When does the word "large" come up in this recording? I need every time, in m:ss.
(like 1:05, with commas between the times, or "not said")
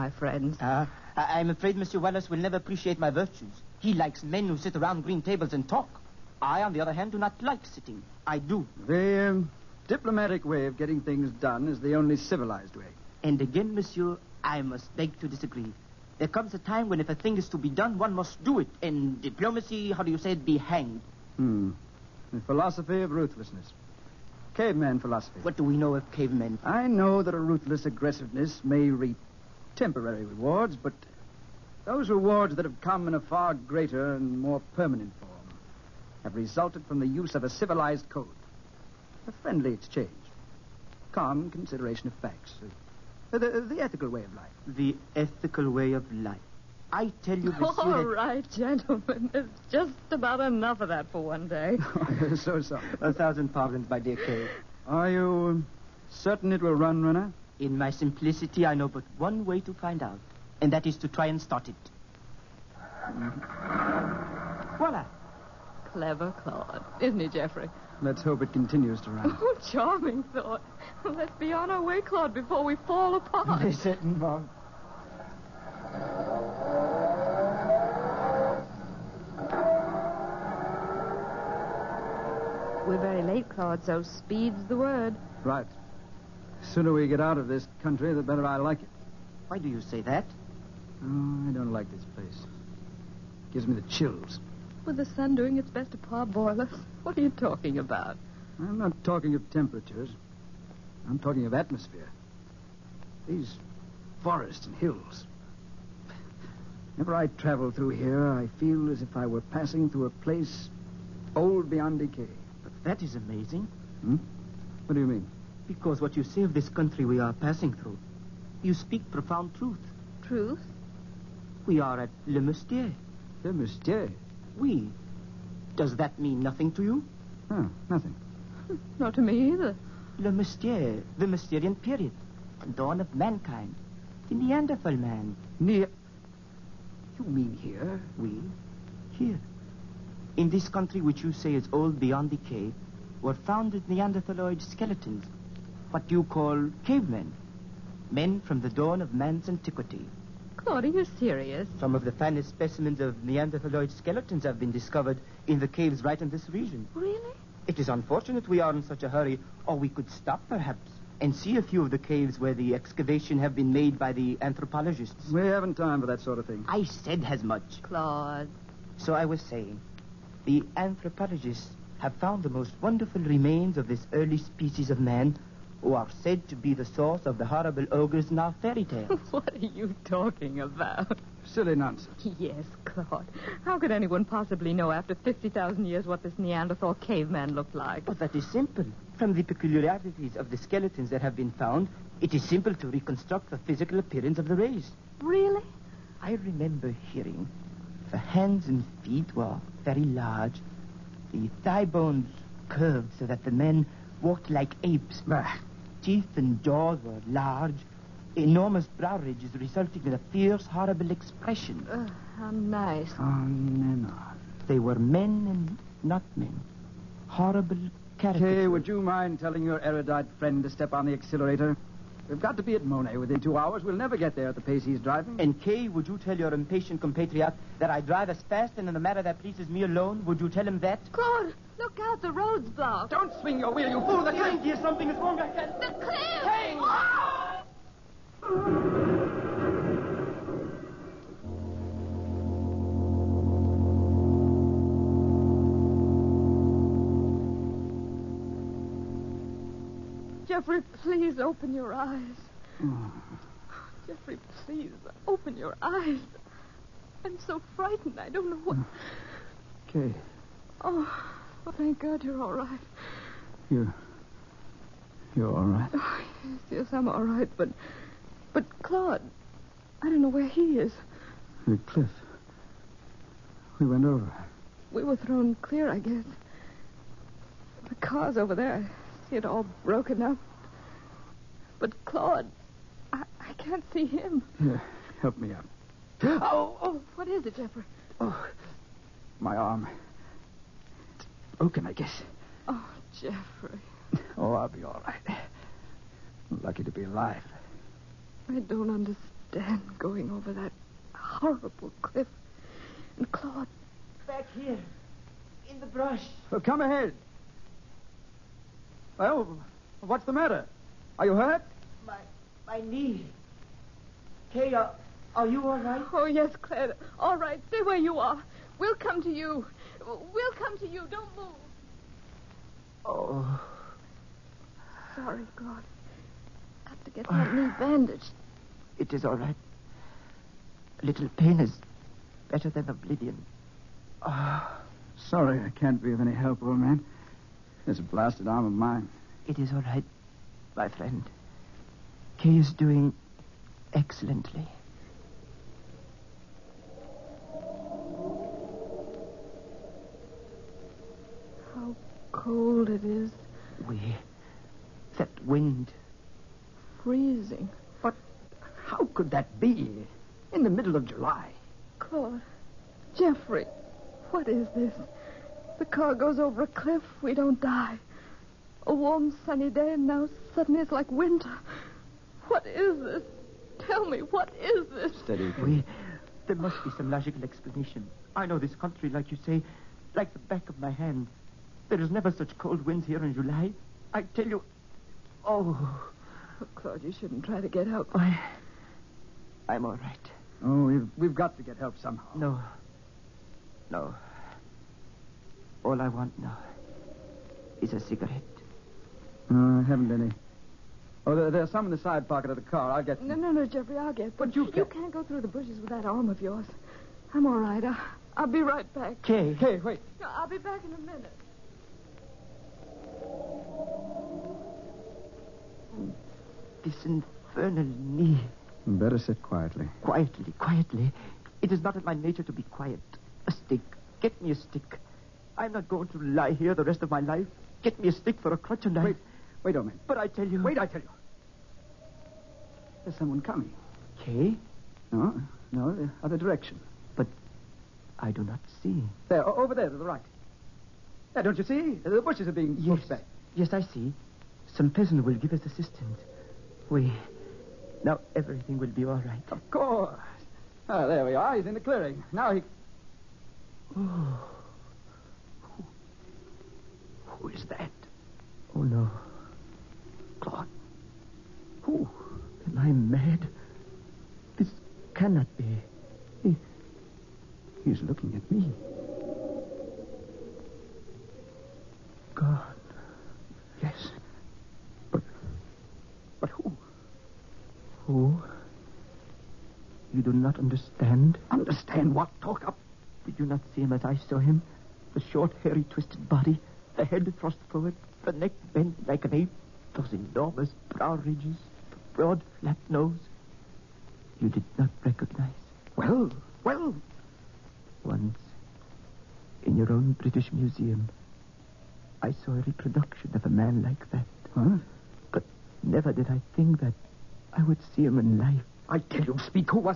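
3:20, 3:27.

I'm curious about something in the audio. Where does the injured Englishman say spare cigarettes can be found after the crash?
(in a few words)
side pocket of the car.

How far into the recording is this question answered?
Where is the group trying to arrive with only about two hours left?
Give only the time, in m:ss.
3:42.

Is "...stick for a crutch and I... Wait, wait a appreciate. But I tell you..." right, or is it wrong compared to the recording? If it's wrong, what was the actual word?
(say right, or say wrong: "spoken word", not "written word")
wrong: "minute", not "appreciate".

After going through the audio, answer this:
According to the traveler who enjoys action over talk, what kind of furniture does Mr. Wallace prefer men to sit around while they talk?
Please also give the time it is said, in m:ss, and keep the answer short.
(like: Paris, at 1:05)
green tables, at 0:05.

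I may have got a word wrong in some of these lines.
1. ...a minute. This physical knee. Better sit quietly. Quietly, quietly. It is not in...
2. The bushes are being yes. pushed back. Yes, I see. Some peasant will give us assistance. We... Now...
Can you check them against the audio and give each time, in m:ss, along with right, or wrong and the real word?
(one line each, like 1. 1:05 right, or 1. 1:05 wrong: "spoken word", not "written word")
1. 6:50 wrong: "infernal", not "physical"
2. 7:22 right.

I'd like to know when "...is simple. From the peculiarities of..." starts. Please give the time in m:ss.
3:08.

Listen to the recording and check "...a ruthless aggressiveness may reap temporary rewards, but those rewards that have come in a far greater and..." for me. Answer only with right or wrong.
right.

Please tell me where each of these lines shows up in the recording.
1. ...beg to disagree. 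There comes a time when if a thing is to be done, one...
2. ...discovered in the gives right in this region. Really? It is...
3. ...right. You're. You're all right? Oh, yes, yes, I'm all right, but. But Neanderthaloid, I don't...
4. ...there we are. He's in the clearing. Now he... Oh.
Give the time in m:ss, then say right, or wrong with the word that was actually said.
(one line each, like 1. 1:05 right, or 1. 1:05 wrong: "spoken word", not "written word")
1. 0:14 right
2. 2:34 wrong: "caves", not "gives"
3. 4:22 wrong: "Claude", not "Neanderthaloid"
4. 7:31 right.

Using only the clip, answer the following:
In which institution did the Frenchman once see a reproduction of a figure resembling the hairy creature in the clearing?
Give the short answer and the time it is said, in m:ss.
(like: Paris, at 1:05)
British Museum, at 8:20.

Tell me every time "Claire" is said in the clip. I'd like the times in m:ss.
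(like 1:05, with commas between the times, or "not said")
5:16.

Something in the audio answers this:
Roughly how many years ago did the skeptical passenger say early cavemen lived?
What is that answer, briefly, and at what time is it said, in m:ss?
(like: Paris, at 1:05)
50,000, at 3:05.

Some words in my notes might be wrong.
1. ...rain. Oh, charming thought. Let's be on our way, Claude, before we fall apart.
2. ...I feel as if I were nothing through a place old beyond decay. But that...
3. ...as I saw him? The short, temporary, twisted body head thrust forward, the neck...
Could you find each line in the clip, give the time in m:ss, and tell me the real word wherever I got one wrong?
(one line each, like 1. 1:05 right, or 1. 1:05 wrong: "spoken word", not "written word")
1. 1:09 right
2. 1:48 wrong: "passing", not "nothing"
3. 8:03 wrong: "hairy", not "temporary".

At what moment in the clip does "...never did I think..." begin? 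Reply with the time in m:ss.
8:25.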